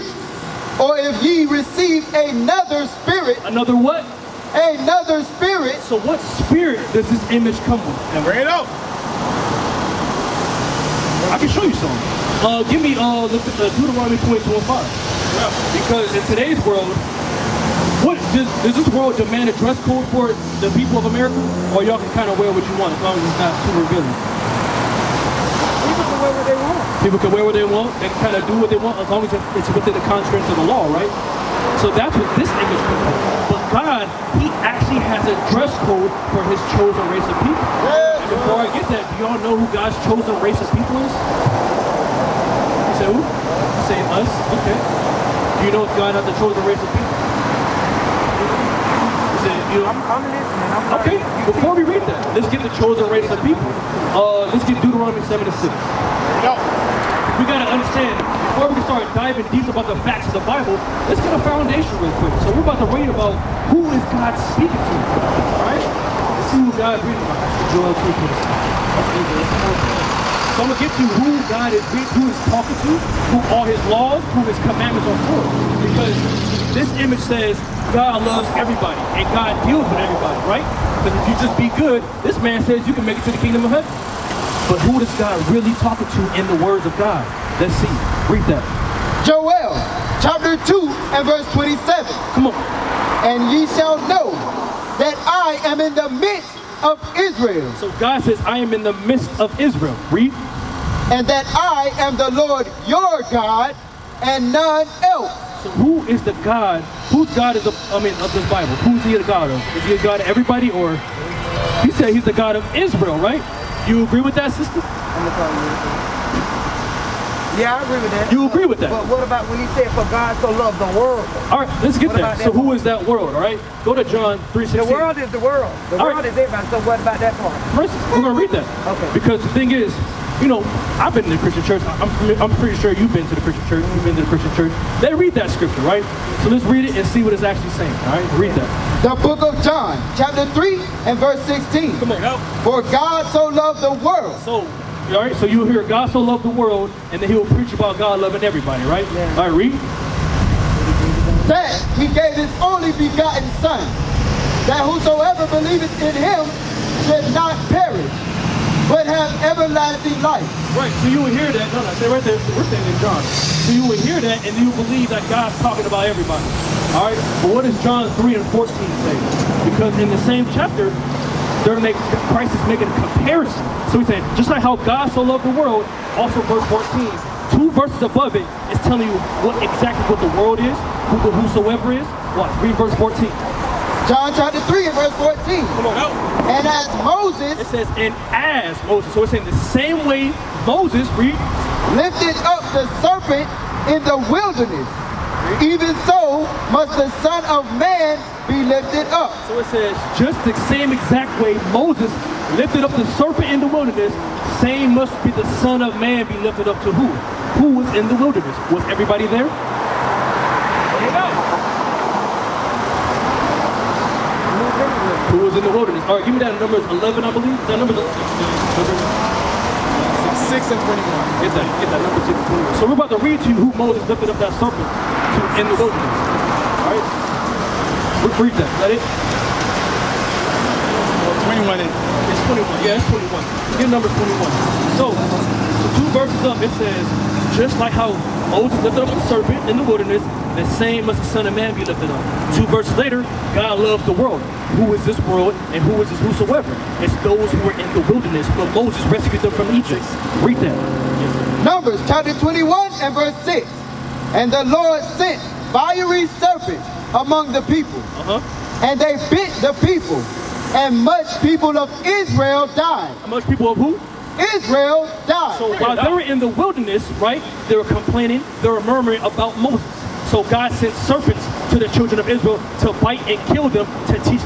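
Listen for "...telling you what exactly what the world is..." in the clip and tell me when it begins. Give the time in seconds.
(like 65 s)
178 s.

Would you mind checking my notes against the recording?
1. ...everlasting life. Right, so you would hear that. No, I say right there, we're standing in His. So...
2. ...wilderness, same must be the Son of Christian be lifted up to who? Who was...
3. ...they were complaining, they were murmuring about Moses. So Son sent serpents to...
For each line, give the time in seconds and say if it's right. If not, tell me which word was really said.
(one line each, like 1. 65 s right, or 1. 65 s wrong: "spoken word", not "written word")
1. 159 s wrong: "John", not "His"
2. 203 s wrong: "Man", not "Christian"
3. 267 s wrong: "God", not "Son".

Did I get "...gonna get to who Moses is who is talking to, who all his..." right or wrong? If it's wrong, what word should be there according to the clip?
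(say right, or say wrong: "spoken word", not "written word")
wrong: "God", not "Moses".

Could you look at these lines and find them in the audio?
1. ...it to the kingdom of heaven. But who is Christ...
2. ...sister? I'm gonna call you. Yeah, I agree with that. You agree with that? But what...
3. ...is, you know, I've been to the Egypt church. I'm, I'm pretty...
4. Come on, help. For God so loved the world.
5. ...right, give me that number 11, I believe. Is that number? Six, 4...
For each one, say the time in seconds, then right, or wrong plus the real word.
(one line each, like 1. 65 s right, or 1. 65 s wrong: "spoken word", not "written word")
1. 83 s wrong: "God", not "Christ"
2. 114 s right
3. 129 s wrong: "Christian", not "Egypt"
4. 141 s right
5. 216 s wrong: "6", not "4".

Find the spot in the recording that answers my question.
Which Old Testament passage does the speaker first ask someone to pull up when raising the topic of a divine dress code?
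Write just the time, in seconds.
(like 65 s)
13 s.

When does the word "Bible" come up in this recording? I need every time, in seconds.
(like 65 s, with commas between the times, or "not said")
60 s, 108 s.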